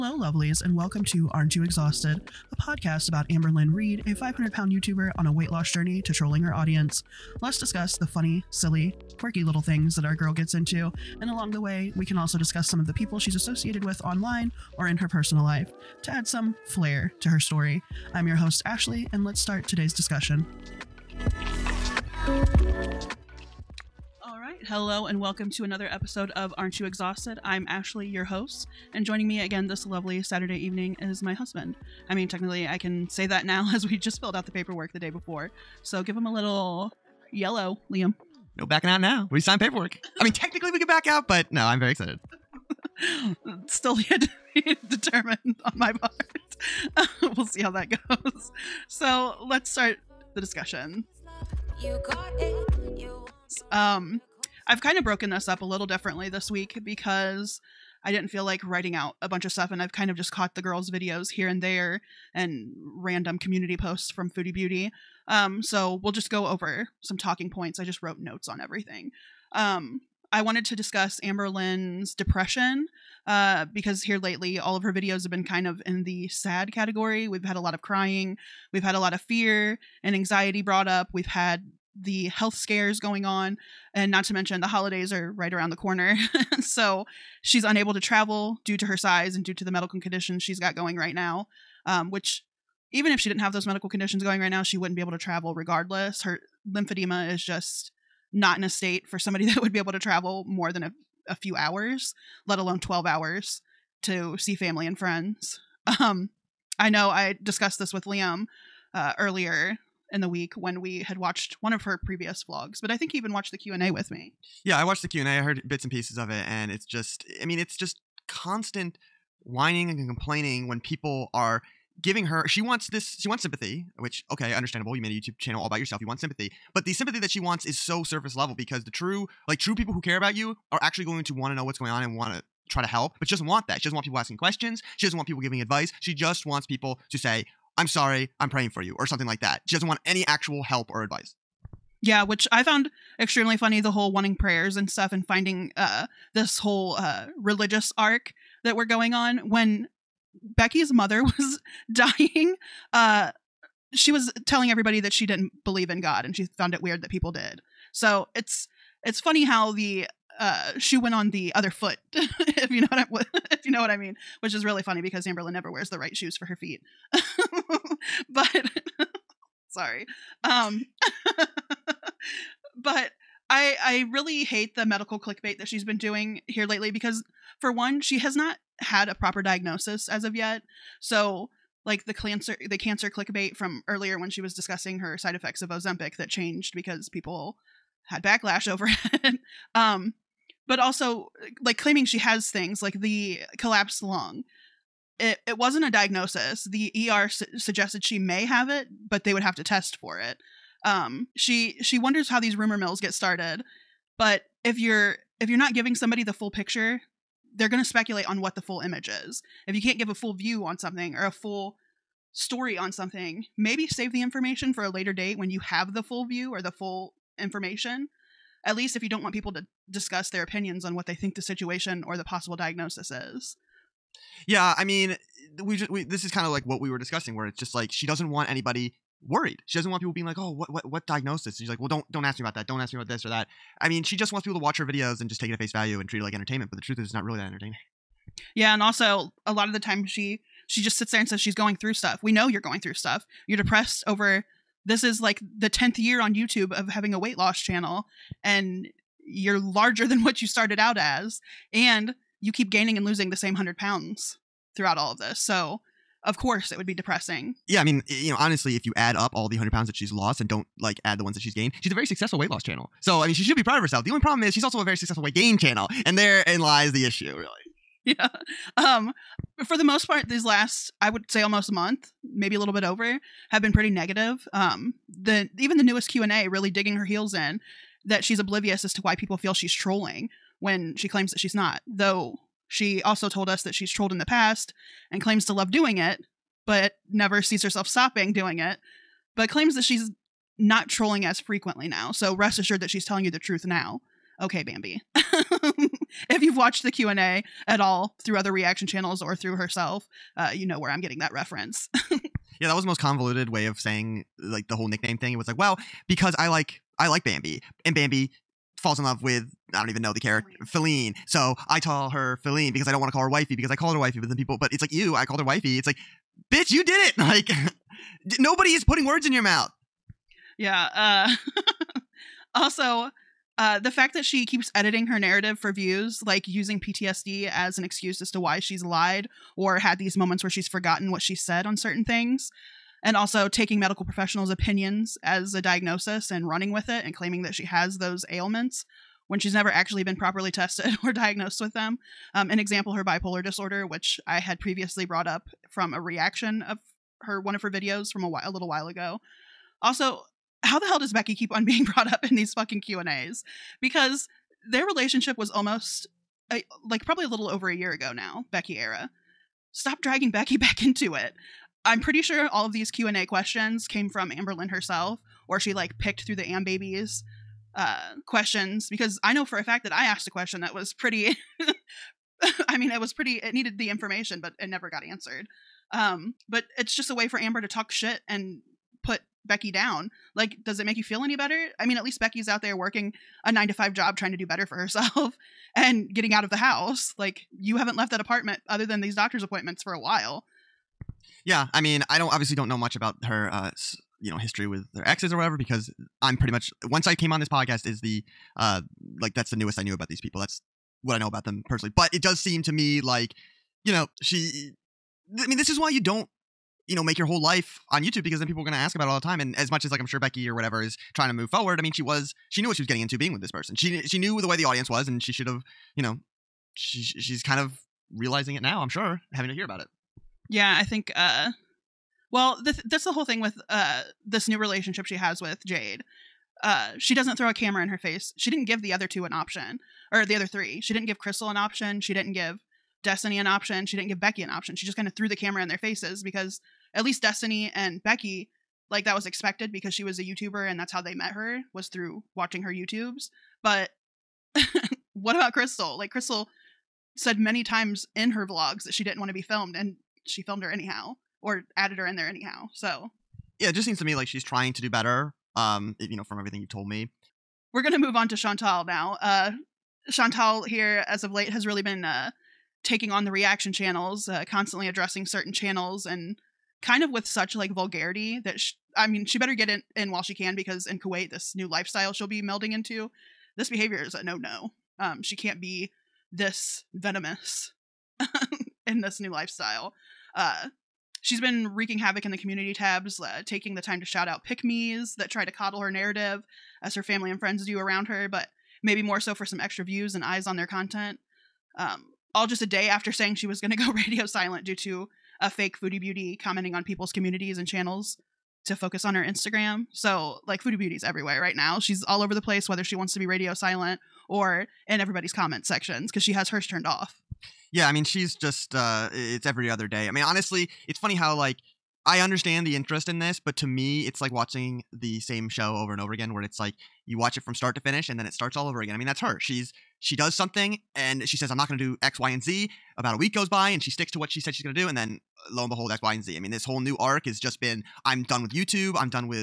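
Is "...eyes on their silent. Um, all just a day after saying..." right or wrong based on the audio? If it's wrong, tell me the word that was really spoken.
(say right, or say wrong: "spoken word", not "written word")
wrong: "content", not "silent".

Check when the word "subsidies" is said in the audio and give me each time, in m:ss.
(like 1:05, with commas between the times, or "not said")
not said.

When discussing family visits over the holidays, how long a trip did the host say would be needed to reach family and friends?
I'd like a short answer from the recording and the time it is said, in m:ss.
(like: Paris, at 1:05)
12 hours, at 1:42.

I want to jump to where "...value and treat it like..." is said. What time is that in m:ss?
3:55.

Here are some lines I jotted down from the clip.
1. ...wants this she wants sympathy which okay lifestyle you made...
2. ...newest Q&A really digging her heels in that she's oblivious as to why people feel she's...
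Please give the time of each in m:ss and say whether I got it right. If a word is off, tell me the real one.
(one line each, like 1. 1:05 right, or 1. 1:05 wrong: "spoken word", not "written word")
1. 2:02 wrong: "understandable", not "lifestyle"
2. 4:35 right.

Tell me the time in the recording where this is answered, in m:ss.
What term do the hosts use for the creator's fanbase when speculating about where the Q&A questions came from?
6:06.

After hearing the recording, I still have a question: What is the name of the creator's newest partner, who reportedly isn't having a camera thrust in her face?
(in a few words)
Jade.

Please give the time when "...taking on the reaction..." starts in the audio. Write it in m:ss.
7:42.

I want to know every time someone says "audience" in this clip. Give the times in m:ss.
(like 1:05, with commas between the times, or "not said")
0:06, 6:54.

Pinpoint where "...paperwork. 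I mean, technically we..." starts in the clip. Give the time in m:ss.
0:39.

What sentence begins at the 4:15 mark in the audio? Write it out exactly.
So, of course it would be depressing.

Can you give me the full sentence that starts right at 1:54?
Yeah, I watched the Q and A.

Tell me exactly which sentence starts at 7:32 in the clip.
So, yeah, it just seems to me like she's trying to do better.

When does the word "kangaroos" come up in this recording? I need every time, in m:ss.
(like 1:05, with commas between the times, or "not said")
not said.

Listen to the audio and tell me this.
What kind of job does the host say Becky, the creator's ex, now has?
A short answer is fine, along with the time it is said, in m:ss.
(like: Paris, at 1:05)
Nine to five, at 6:23.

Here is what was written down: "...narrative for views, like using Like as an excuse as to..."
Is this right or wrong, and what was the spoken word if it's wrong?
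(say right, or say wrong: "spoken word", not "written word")
wrong: "PTSD", not "Like".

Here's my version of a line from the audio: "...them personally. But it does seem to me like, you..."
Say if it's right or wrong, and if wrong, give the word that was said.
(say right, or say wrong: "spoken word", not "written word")
right.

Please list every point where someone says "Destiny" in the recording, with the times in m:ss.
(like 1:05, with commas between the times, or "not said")
7:13, 7:17.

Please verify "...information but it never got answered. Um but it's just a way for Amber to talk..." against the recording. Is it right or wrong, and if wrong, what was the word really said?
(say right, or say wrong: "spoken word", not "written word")
right.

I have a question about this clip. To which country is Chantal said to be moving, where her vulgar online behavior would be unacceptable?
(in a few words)
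Kuwait.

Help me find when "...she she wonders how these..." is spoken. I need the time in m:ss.
3:21.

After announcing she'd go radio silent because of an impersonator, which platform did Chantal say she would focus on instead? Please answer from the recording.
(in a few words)
Instagram.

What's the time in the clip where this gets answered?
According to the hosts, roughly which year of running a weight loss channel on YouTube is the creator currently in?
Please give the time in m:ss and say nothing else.
4:05.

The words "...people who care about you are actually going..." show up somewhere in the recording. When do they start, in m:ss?
2:09.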